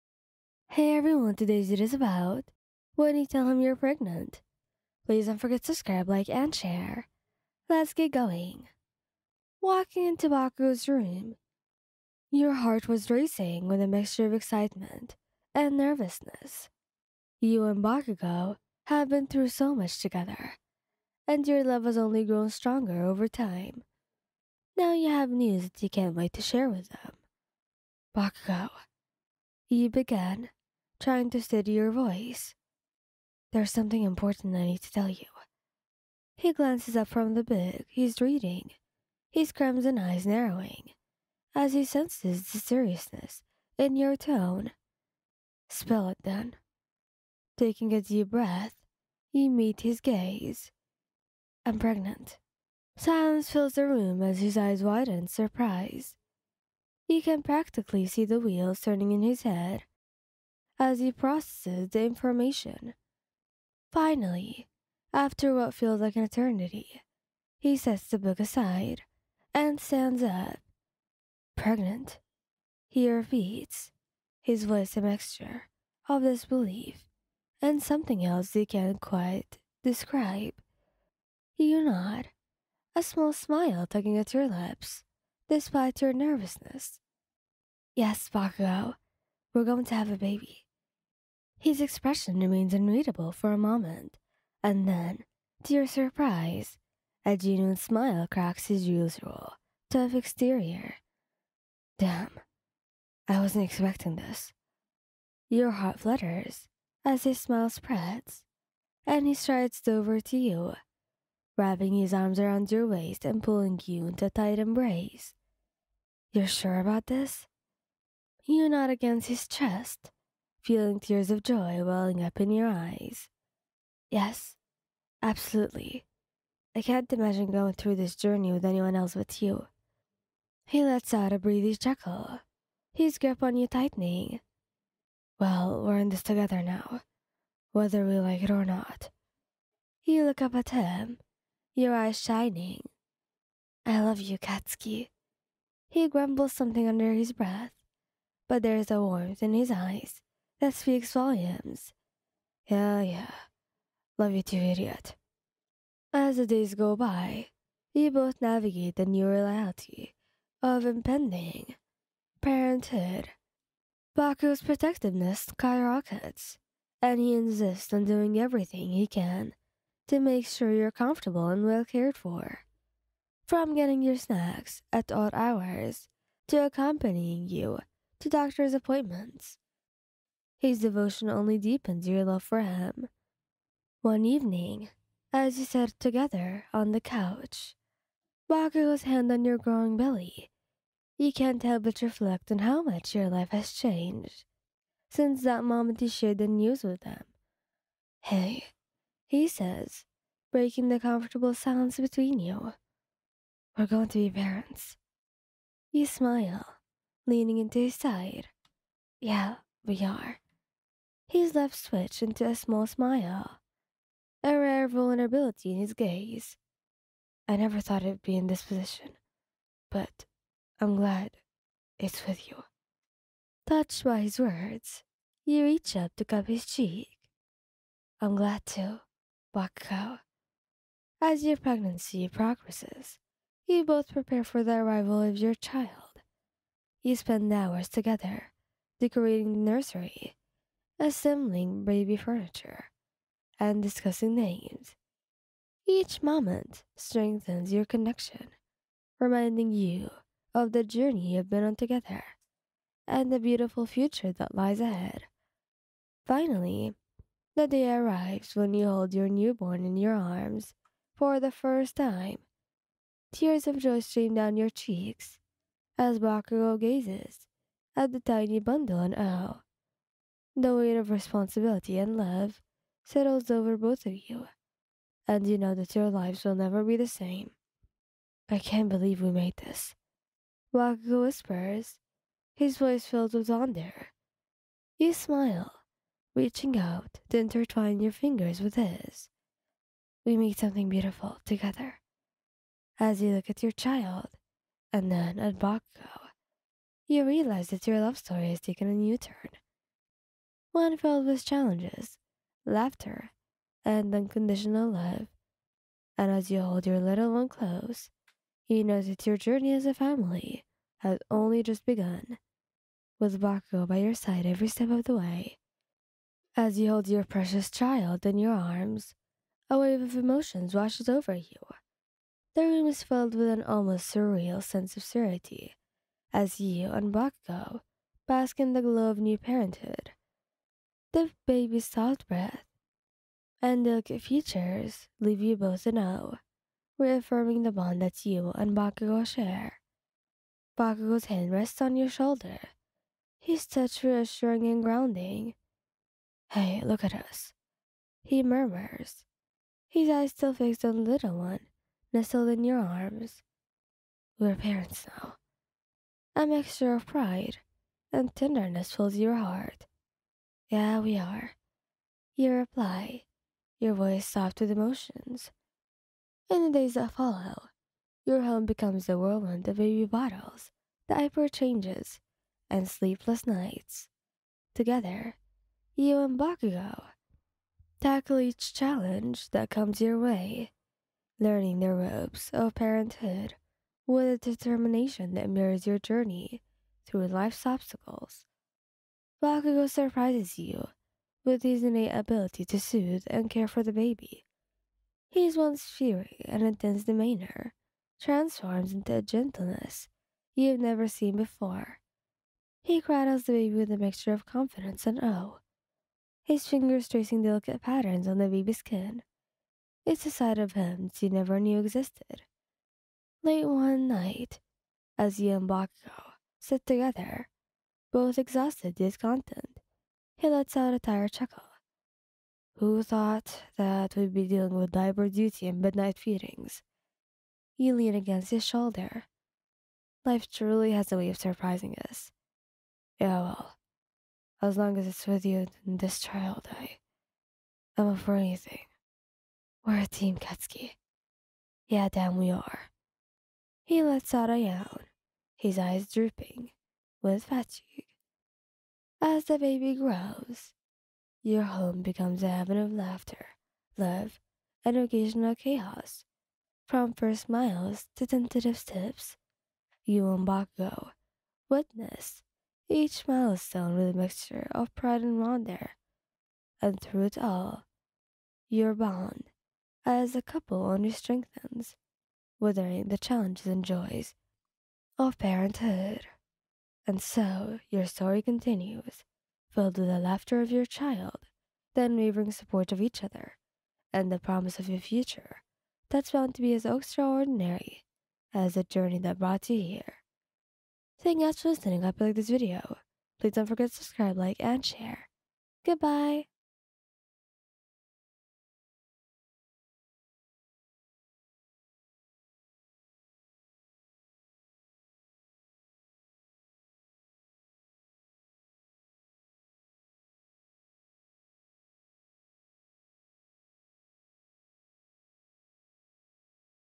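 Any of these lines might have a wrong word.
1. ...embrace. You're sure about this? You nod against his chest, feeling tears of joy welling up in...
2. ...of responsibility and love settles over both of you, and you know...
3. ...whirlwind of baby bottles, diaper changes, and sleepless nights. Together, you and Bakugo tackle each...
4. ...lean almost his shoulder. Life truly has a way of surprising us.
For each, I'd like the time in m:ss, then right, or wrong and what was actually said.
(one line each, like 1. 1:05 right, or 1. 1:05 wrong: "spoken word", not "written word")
1. 1:54 right
2. 4:30 right
3. 6:09 right
4. 7:07 wrong: "against", not "almost".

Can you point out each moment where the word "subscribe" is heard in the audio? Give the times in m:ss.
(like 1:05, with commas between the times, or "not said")
0:05, 8:13.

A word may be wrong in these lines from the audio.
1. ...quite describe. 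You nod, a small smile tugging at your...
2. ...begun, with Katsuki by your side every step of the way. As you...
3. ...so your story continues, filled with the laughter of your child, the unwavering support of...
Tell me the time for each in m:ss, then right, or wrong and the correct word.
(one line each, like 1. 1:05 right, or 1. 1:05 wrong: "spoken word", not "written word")
1. 1:18 right
2. 5:11 wrong: "Bakugo", not "Katsuki"
3. 7:57 right.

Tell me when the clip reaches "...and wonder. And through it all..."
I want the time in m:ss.
7:45.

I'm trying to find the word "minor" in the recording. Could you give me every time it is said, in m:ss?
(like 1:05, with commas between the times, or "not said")
not said.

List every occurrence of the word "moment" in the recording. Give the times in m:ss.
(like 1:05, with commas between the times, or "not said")
1:33, 3:15, 4:06.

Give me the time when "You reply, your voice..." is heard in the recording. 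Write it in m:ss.
6:02.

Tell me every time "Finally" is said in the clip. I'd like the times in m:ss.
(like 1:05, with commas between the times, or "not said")
1:03, 4:16.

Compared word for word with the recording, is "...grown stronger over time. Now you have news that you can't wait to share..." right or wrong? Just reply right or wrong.
right.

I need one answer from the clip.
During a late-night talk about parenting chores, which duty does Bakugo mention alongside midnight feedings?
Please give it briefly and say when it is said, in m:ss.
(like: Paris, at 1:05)
Diaper duty, at 7:04.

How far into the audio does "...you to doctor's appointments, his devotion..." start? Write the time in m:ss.
2:57.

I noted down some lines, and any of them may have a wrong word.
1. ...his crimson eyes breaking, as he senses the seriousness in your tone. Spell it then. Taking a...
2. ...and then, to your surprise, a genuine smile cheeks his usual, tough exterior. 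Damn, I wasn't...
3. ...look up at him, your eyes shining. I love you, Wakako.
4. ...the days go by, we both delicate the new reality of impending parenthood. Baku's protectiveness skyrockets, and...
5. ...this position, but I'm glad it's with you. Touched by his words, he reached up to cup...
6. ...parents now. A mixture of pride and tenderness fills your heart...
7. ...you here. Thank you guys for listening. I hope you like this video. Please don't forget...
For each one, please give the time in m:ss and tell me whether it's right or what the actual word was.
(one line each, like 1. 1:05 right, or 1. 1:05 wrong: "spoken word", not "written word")
1. 0:39 wrong: "narrowing", not "breaking"
2. 1:34 wrong: "cracks", not "cheeks"
3. 2:20 wrong: "Katsuki", not "Wakako"
4. 2:36 wrong: "navigate", not "delicate"
5. 3:38 right
6. 5:54 right
7. 8:09 right.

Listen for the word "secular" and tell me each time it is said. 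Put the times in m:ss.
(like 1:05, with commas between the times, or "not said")
not said.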